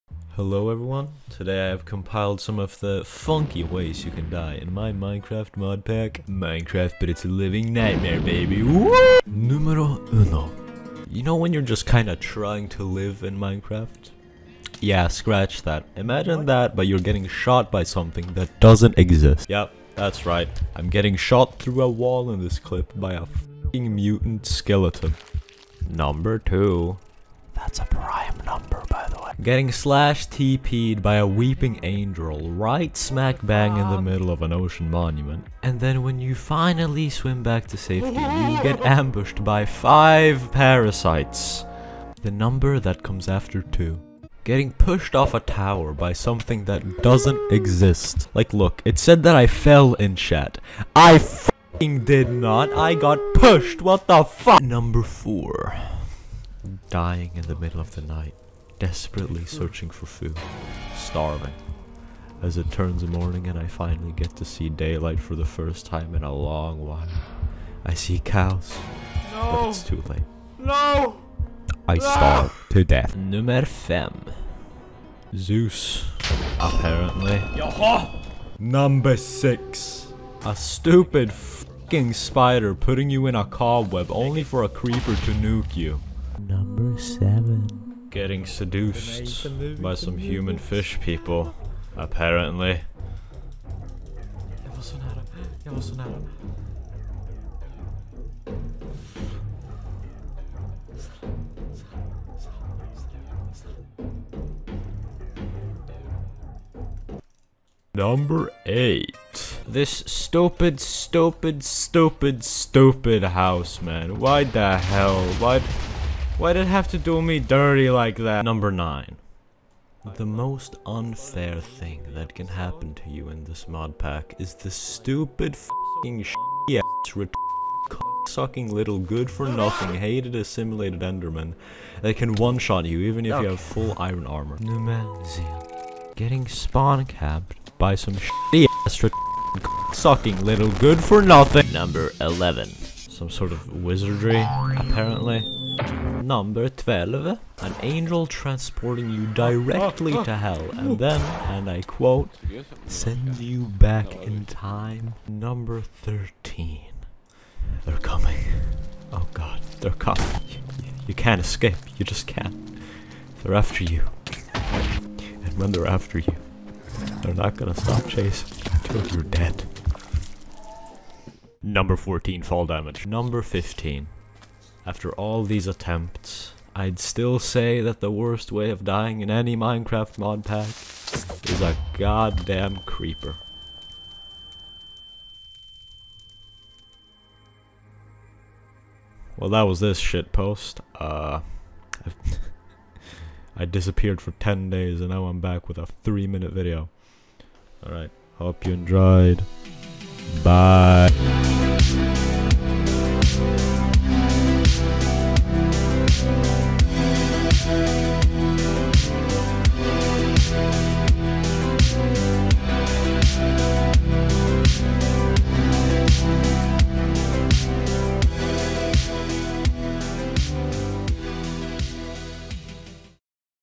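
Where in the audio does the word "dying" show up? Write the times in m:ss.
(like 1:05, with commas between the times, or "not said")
0:56, 2:58.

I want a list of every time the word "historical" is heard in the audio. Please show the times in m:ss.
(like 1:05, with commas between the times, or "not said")
not said.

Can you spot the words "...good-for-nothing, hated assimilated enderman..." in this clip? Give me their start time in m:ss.
2:08.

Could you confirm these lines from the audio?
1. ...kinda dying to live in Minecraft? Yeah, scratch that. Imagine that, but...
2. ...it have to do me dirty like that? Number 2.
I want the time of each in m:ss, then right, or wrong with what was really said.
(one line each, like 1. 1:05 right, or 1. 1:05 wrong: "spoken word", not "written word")
1. 0:11 wrong: "trying", not "dying"
2. 1:56 wrong: "9", not "2".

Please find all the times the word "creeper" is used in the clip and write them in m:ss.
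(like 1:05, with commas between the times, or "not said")
1:24, 3:02.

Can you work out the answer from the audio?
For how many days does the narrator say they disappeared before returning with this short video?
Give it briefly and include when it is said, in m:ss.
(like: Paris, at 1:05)
10, at 3:14.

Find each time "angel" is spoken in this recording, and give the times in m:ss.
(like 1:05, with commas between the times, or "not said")
0:31, 2:27.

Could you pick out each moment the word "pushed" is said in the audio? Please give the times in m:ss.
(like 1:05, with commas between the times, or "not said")
0:44, 0:53.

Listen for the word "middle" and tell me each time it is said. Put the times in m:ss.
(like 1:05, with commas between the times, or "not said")
0:34, 0:57.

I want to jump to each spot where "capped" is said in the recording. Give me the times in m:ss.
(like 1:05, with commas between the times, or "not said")
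2:16.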